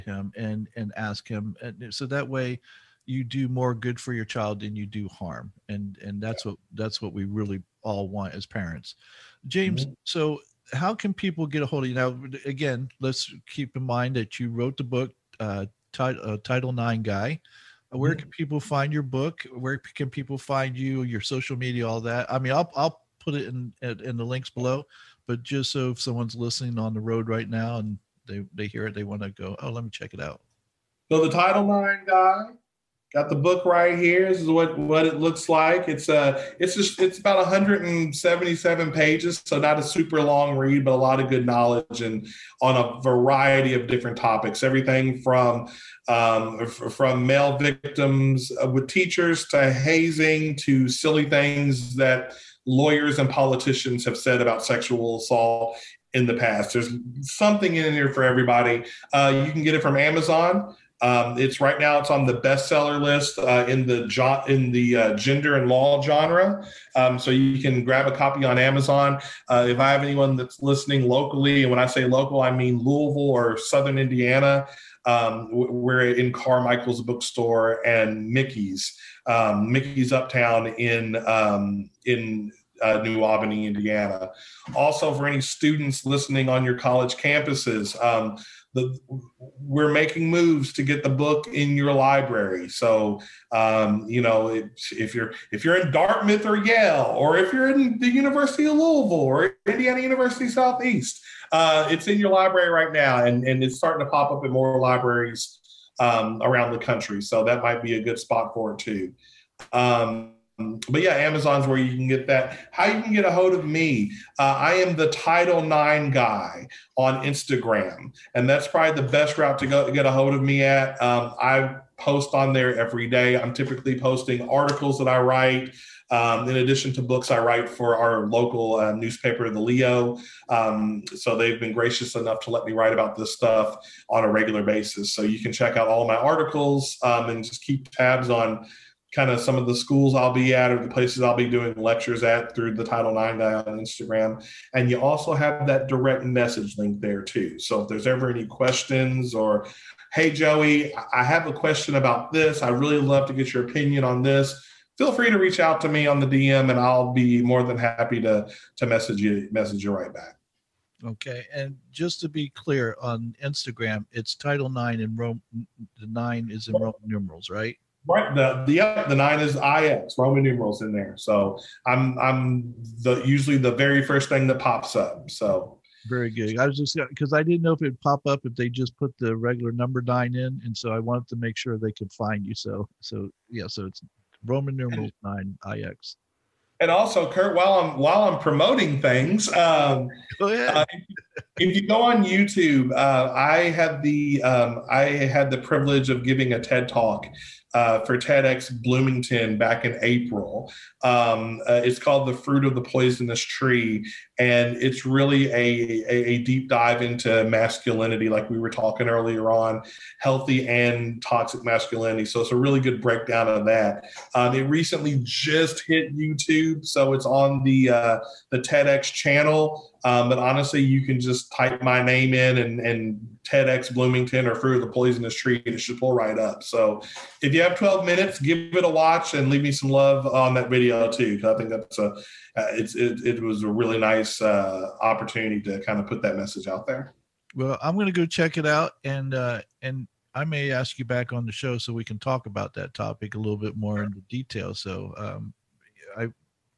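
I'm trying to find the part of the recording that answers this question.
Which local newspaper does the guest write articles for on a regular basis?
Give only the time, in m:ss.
2:09.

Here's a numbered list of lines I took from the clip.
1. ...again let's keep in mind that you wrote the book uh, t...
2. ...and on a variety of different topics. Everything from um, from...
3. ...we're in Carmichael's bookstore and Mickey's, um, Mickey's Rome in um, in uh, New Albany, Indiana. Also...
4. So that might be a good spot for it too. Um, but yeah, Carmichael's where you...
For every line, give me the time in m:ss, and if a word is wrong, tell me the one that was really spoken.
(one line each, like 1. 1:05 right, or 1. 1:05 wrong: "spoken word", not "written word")
1. 0:12 right
2. 0:42 right
3. 1:15 wrong: "Uptown", not "Rome"
4. 1:47 wrong: "Amazon", not "Carmichael".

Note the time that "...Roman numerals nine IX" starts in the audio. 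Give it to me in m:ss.
3:04.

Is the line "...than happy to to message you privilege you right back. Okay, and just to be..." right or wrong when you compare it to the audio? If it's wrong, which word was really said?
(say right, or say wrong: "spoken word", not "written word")
wrong: "message", not "privilege".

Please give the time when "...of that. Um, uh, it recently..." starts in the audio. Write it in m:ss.
3:33.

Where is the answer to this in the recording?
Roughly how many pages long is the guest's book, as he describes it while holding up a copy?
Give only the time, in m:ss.
0:37.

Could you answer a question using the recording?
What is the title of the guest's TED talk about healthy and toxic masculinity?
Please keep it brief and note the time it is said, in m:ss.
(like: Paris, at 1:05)
The Fruit of the Poisonous Tree, at 3:22.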